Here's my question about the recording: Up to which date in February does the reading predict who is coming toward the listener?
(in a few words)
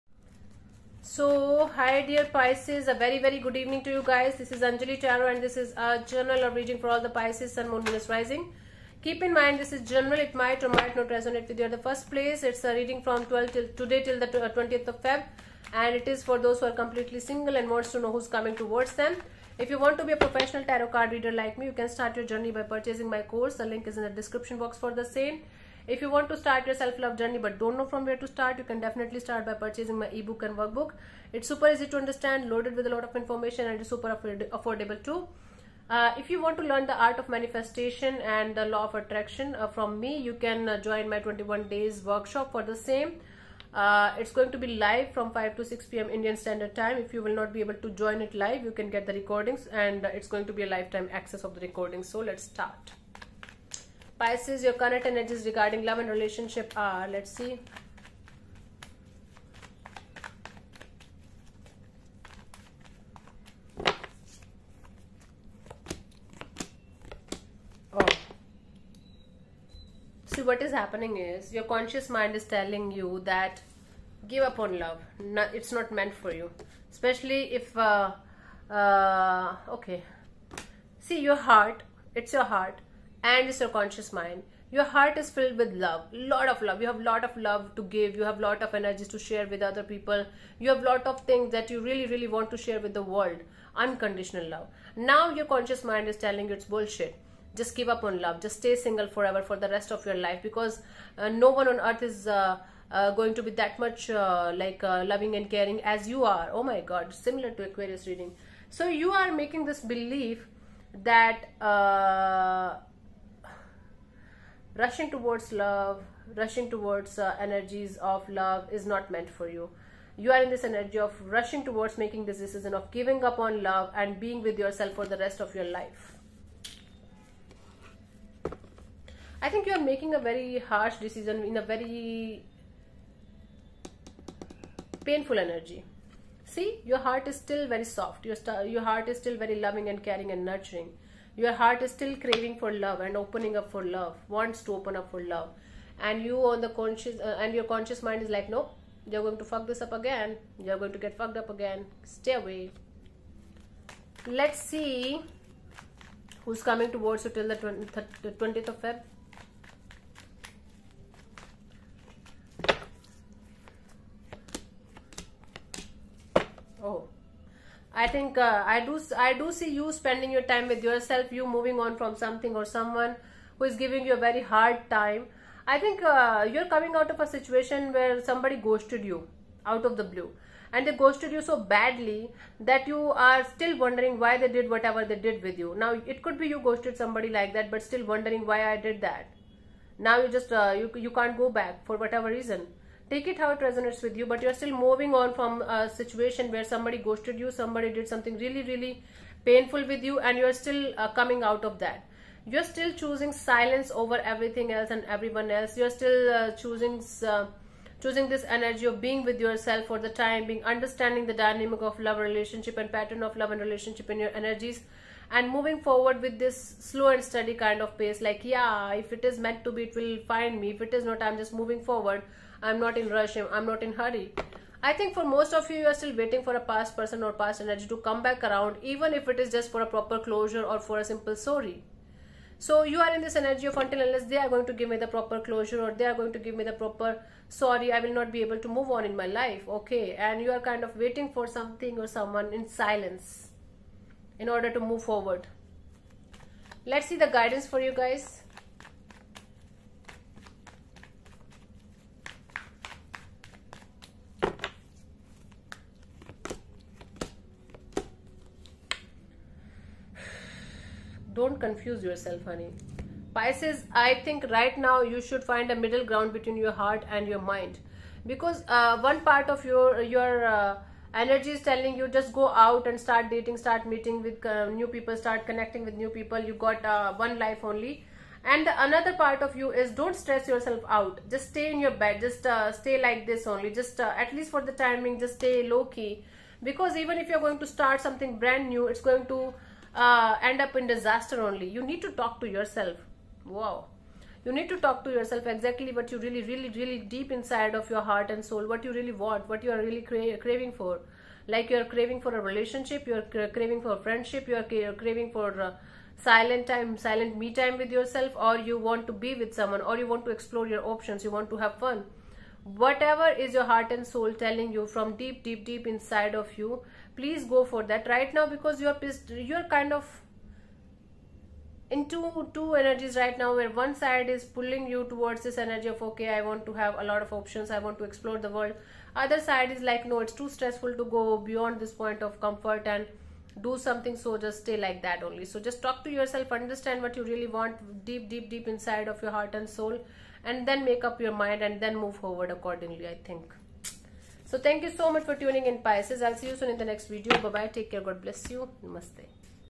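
20th.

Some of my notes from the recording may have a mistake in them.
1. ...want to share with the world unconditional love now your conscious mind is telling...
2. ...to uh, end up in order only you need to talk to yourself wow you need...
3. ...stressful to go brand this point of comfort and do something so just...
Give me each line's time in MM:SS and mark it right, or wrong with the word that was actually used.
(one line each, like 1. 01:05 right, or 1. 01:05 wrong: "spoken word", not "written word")
1. 01:32 right
2. 04:49 wrong: "disaster", not "order"
3. 05:30 wrong: "beyond", not "brand".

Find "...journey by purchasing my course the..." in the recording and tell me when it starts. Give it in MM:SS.
00:22.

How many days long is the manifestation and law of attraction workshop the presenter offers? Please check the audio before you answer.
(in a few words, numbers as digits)
21.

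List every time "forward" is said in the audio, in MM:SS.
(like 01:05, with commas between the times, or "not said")
03:35, 03:41, 04:05, 05:42.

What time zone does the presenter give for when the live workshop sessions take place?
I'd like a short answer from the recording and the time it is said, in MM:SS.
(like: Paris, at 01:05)
Indian Standard Time, at 00:46.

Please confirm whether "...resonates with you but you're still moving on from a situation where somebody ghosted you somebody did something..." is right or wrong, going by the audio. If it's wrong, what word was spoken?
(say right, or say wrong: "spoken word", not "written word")
right.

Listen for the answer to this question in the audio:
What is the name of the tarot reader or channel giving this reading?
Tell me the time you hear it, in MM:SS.
00:04.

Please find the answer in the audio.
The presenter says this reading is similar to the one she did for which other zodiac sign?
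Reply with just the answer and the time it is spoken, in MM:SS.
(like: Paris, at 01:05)
Aquarius, at 01:47.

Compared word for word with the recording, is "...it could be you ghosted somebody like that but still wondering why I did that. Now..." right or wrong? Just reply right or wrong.
right.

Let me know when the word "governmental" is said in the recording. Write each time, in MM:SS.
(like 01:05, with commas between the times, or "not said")
not said.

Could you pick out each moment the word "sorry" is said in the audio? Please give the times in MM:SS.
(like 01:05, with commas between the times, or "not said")
03:51, 03:57.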